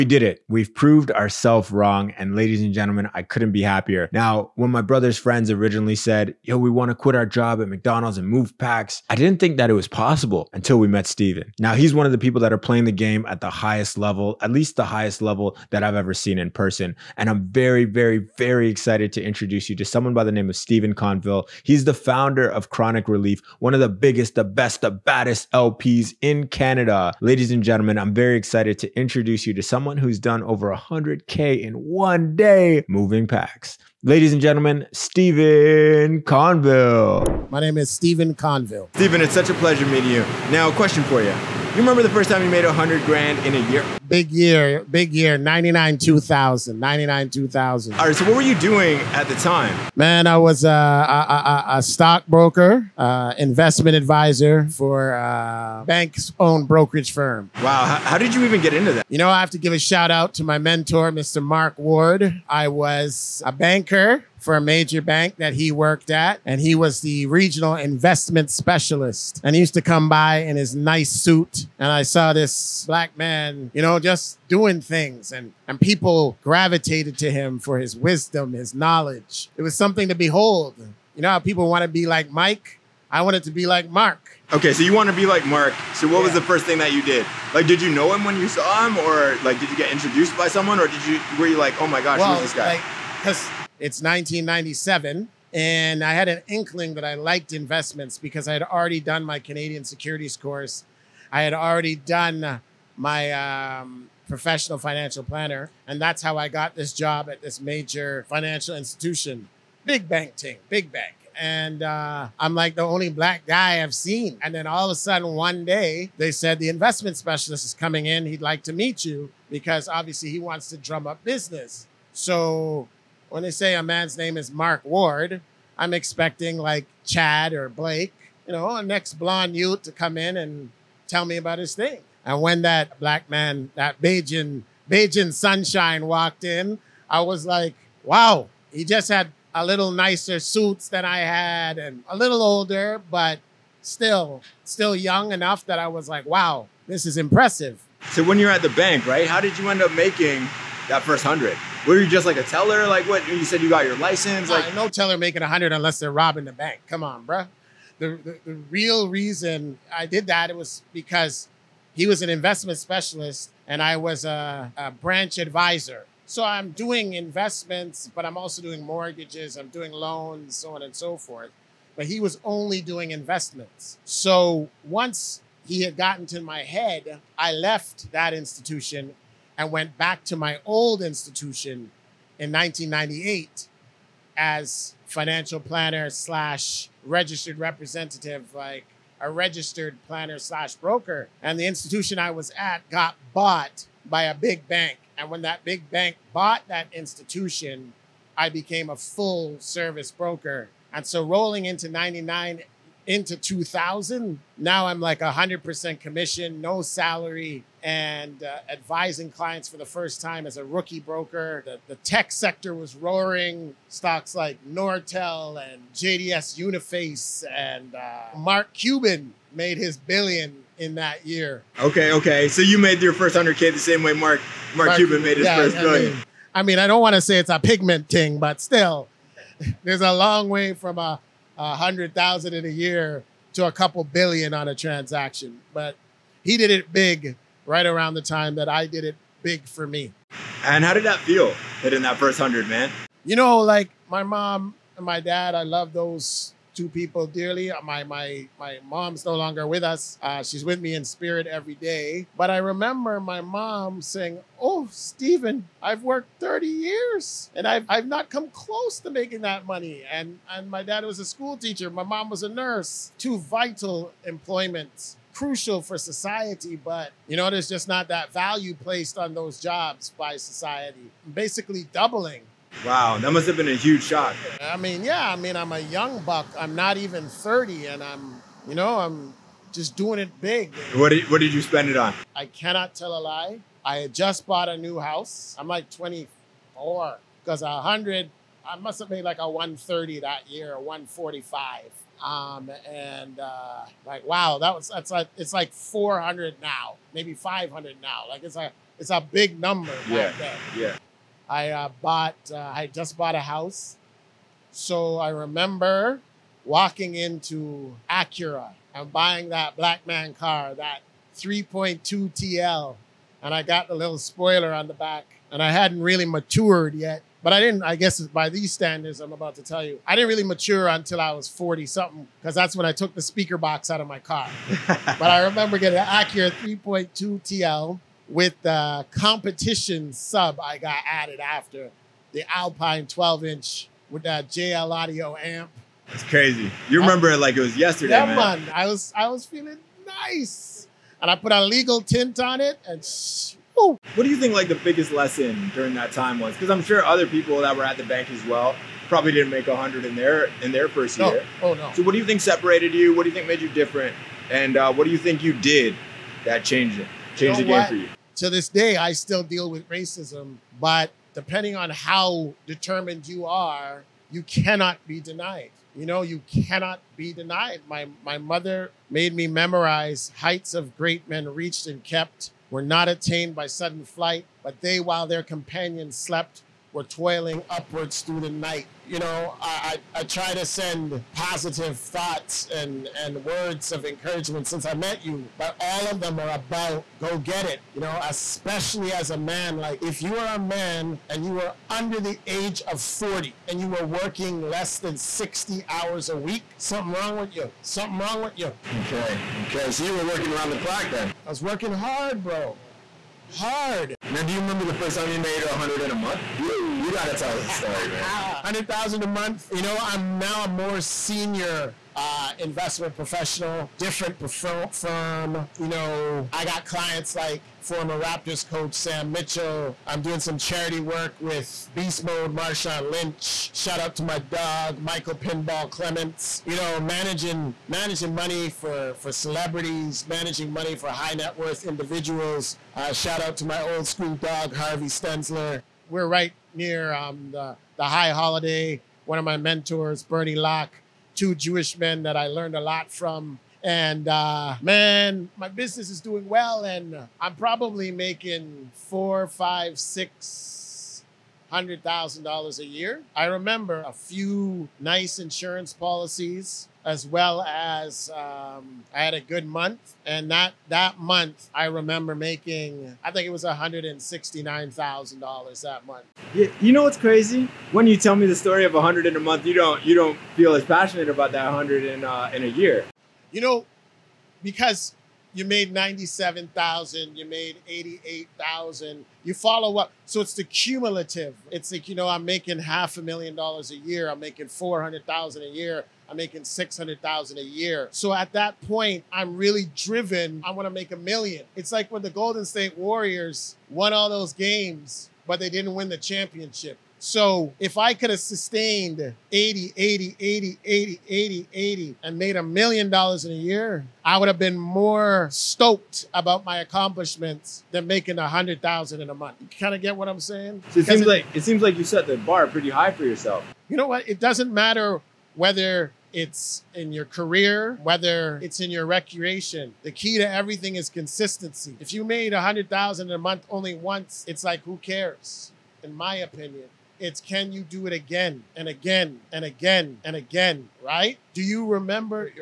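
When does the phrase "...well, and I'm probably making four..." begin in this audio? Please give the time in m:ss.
7:26.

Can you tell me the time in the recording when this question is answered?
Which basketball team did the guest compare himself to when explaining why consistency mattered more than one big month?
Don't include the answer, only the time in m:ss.
8:12.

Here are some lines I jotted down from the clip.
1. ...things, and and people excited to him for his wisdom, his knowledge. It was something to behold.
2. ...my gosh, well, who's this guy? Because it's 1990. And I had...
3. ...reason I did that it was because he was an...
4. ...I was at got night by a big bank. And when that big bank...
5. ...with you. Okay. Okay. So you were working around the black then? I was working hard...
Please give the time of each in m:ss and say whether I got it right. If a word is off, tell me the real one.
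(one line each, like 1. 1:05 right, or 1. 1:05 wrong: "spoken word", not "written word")
1. 1:14 wrong: "gravitated", not "excited"
2. 1:31 wrong: "1997", not "1990"
3. 2:39 right
4. 3:12 wrong: "bought", not "night"
5. 6:38 wrong: "clock", not "black".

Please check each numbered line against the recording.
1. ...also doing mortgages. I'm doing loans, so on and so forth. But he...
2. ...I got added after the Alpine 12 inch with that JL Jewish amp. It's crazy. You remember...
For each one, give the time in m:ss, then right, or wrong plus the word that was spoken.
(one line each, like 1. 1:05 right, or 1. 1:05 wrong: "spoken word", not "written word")
1. 2:48 right
2. 5:30 wrong: "Audio", not "Jewish".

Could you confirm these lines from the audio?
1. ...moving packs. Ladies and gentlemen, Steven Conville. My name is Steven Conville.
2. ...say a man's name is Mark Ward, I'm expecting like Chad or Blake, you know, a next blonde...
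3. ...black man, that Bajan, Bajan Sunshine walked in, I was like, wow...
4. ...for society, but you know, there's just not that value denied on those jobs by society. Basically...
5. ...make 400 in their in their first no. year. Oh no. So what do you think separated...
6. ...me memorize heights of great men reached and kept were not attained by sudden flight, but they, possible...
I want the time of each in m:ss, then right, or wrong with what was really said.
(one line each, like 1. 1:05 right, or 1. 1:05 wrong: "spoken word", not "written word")
1. 0:32 right
2. 2:03 right
3. 2:12 right
4. 4:25 wrong: "placed", not "denied"
5. 5:49 wrong: "100", not "400"
6. 6:09 wrong: "while", not "possible".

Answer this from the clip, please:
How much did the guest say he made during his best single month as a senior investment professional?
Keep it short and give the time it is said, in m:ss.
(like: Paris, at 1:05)
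$169,000, at 7:43.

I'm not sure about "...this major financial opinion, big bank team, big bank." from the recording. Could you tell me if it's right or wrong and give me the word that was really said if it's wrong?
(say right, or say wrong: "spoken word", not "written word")
wrong: "institution", not "opinion".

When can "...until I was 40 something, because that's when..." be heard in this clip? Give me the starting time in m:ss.
5:20.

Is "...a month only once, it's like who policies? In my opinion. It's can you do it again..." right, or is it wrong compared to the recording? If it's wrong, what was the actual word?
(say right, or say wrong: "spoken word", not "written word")
wrong: "cares", not "policies".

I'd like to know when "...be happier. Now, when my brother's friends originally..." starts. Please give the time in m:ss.
0:03.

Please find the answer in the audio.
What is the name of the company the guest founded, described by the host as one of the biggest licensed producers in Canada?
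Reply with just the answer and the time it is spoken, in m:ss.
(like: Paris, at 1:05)
Kronic Relief, at 0:22.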